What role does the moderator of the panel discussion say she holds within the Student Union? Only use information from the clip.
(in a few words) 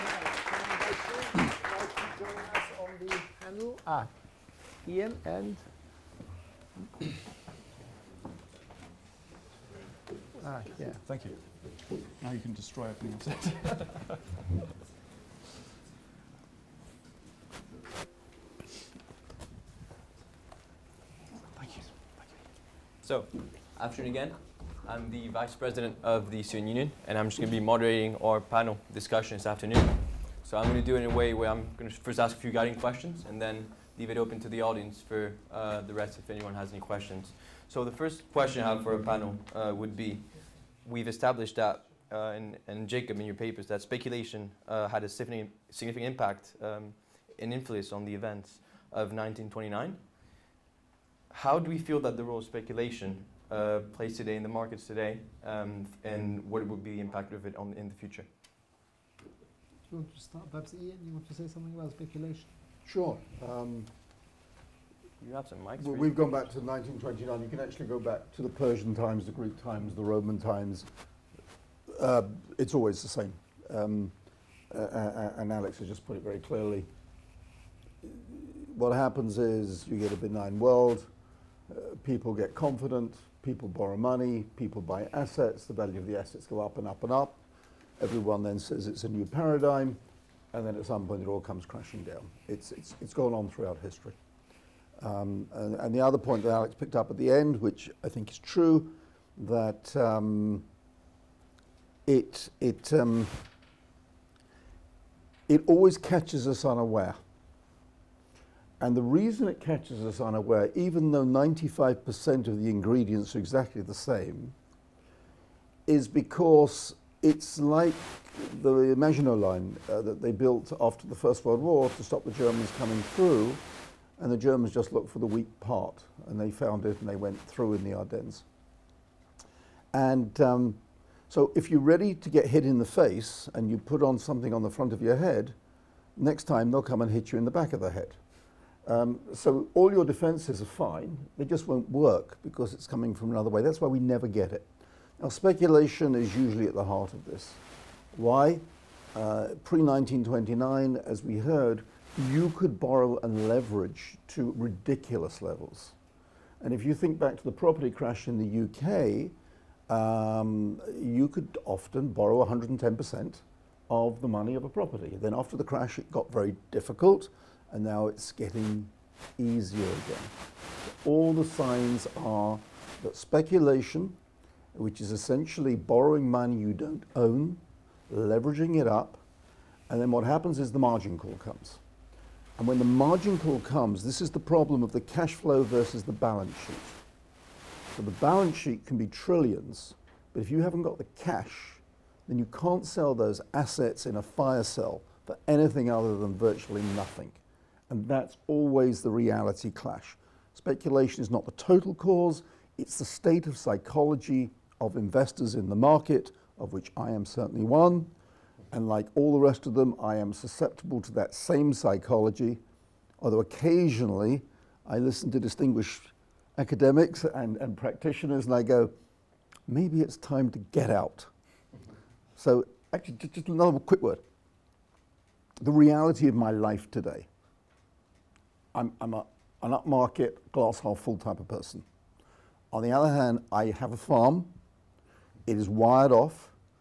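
Vice President.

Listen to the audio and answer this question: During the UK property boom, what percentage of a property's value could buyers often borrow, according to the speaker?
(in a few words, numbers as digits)
110%.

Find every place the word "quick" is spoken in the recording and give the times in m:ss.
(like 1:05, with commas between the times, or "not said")
3:43.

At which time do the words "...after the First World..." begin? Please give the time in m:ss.
2:00.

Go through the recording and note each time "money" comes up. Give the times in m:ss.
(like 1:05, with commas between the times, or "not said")
1:23, 2:44, 2:56.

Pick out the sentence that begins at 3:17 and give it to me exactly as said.
And that's always the reality clash.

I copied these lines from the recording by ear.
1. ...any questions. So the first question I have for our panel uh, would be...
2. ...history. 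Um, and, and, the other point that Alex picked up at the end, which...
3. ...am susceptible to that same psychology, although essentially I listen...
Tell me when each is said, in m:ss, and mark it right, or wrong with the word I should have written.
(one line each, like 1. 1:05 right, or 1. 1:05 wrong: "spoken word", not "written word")
1. 0:36 right
2. 1:33 right
3. 3:30 wrong: "occasionally", not "essentially".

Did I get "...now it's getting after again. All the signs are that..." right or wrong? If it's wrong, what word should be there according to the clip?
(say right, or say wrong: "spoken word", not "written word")
wrong: "easier", not "after".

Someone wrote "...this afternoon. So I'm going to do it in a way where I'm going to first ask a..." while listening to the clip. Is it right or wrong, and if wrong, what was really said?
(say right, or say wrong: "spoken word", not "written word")
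right.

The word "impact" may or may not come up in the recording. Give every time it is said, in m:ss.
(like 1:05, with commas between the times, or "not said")
0:46, 0:56.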